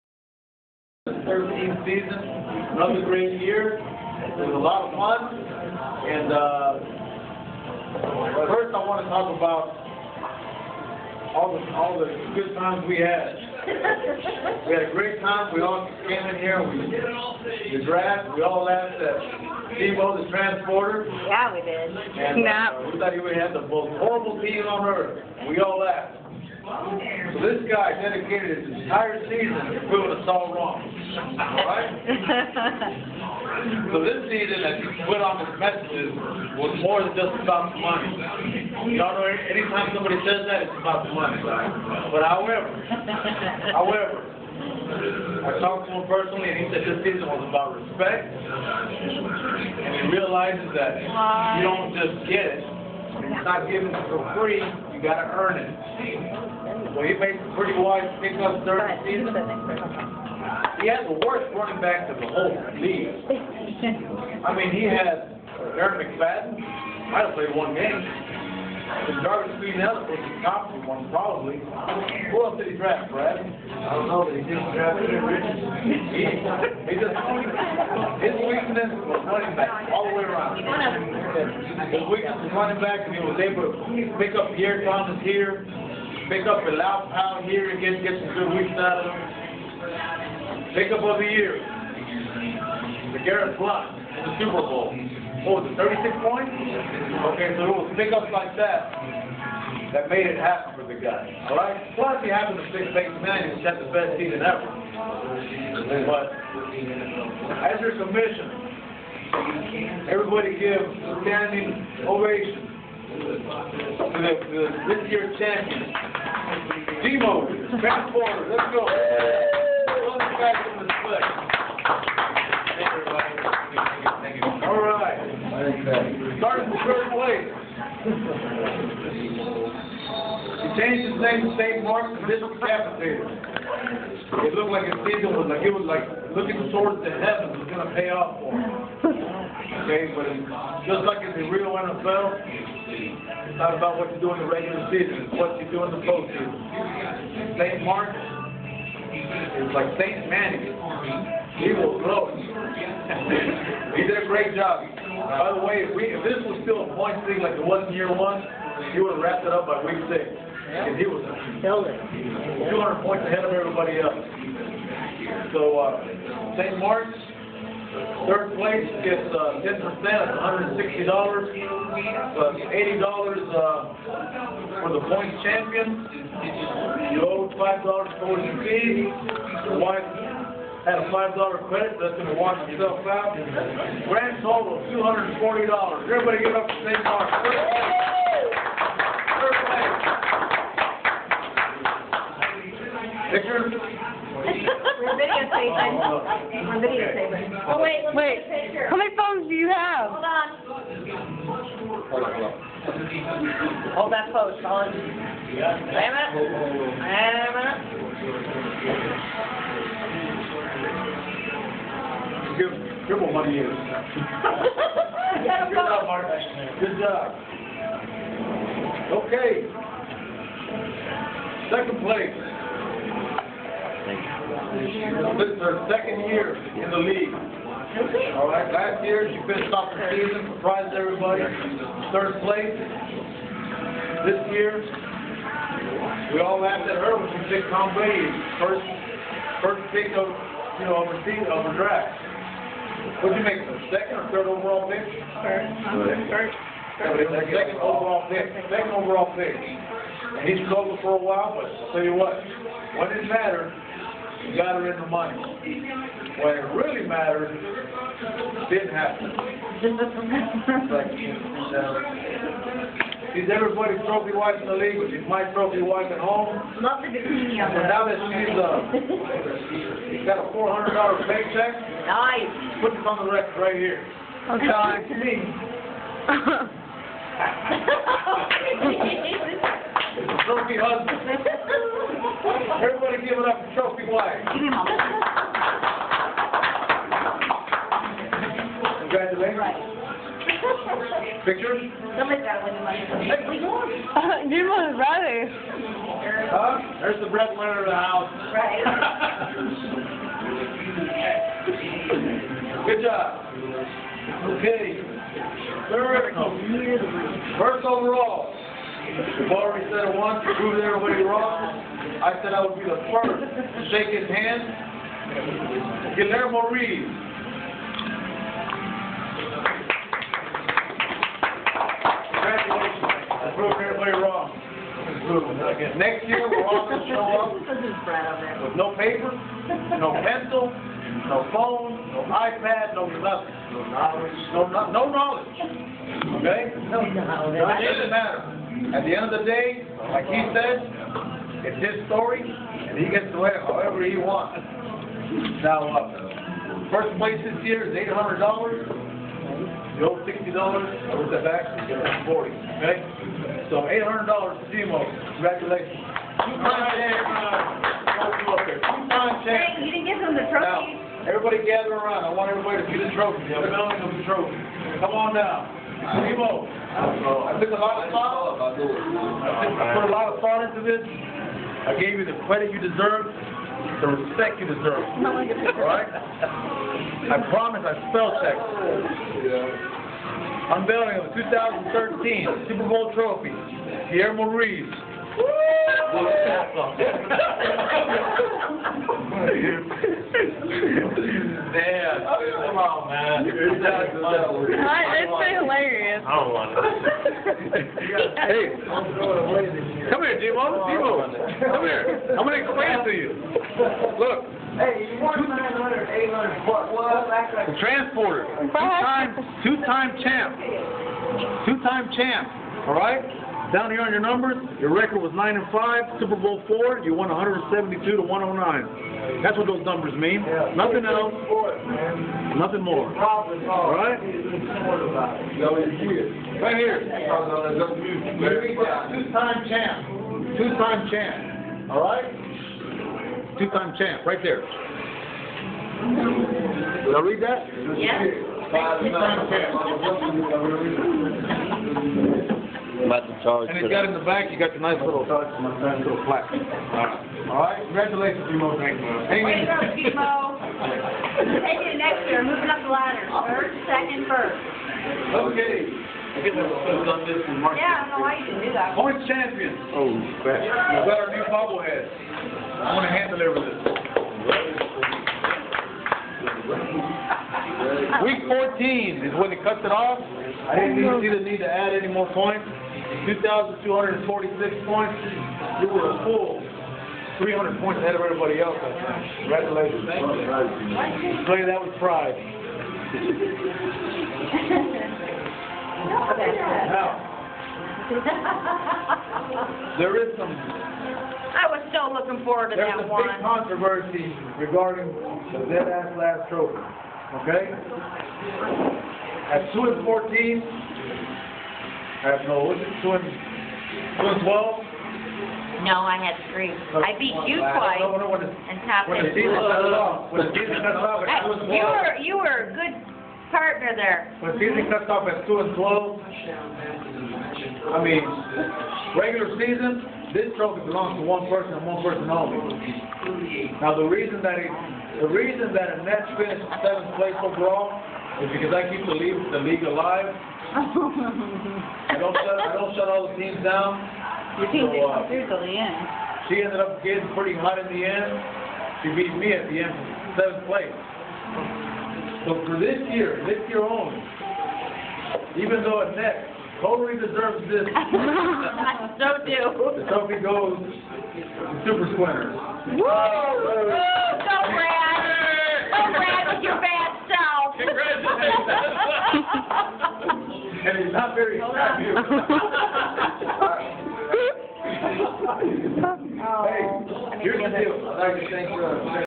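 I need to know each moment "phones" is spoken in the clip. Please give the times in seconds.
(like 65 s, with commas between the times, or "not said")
199 s, 331 s.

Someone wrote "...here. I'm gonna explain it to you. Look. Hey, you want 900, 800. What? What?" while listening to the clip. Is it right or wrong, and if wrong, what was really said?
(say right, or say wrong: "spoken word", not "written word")
right.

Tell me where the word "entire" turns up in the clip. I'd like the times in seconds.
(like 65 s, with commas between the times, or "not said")
28 s.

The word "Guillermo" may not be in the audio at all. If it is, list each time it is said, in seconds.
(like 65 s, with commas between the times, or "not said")
316 s, 384 s.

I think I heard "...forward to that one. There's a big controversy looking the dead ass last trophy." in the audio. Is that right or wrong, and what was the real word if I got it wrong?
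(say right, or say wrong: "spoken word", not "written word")
wrong: "regarding", not "looking".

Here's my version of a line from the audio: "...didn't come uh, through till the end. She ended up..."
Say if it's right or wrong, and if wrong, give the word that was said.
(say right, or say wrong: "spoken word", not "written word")
right.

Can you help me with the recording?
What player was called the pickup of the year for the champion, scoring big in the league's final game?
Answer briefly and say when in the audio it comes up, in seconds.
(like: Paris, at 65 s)
LeGarrette Blount, at 93 s.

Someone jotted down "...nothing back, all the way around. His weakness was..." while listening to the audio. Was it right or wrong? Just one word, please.
wrong.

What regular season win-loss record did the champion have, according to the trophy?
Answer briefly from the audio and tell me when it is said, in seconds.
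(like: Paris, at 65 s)
9 and 5, at 415 s.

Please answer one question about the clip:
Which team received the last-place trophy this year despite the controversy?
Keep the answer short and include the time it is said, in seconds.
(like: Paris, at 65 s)
Super Squinters, at 551 s.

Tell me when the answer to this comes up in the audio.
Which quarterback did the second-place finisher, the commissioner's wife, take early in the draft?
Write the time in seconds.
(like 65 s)
237 s.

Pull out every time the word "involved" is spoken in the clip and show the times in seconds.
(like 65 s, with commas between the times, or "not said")
not said.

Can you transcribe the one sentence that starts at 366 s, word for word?
I put a lot of thought into this.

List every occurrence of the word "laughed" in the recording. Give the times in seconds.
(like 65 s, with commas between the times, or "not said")
18 s, 25 s, 236 s.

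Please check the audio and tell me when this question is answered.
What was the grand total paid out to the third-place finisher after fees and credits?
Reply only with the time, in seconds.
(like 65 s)
184 s.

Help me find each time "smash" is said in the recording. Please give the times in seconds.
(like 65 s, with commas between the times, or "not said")
not said.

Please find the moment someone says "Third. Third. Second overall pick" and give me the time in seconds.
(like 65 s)
245 s.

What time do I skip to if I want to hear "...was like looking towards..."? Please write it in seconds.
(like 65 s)
135 s.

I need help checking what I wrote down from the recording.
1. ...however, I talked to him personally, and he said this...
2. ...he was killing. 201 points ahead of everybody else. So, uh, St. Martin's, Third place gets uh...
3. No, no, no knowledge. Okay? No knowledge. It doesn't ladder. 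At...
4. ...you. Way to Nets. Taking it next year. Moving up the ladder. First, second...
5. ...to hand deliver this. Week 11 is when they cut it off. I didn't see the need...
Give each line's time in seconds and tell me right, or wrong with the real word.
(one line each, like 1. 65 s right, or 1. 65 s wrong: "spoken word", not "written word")
1. 43 s right
2. 160 s wrong: "200", not "201"
3. 334 s wrong: "matter", not "ladder"
4. 449 s wrong: "Emo", not "Nets"
5. 463 s wrong: "14", not "11".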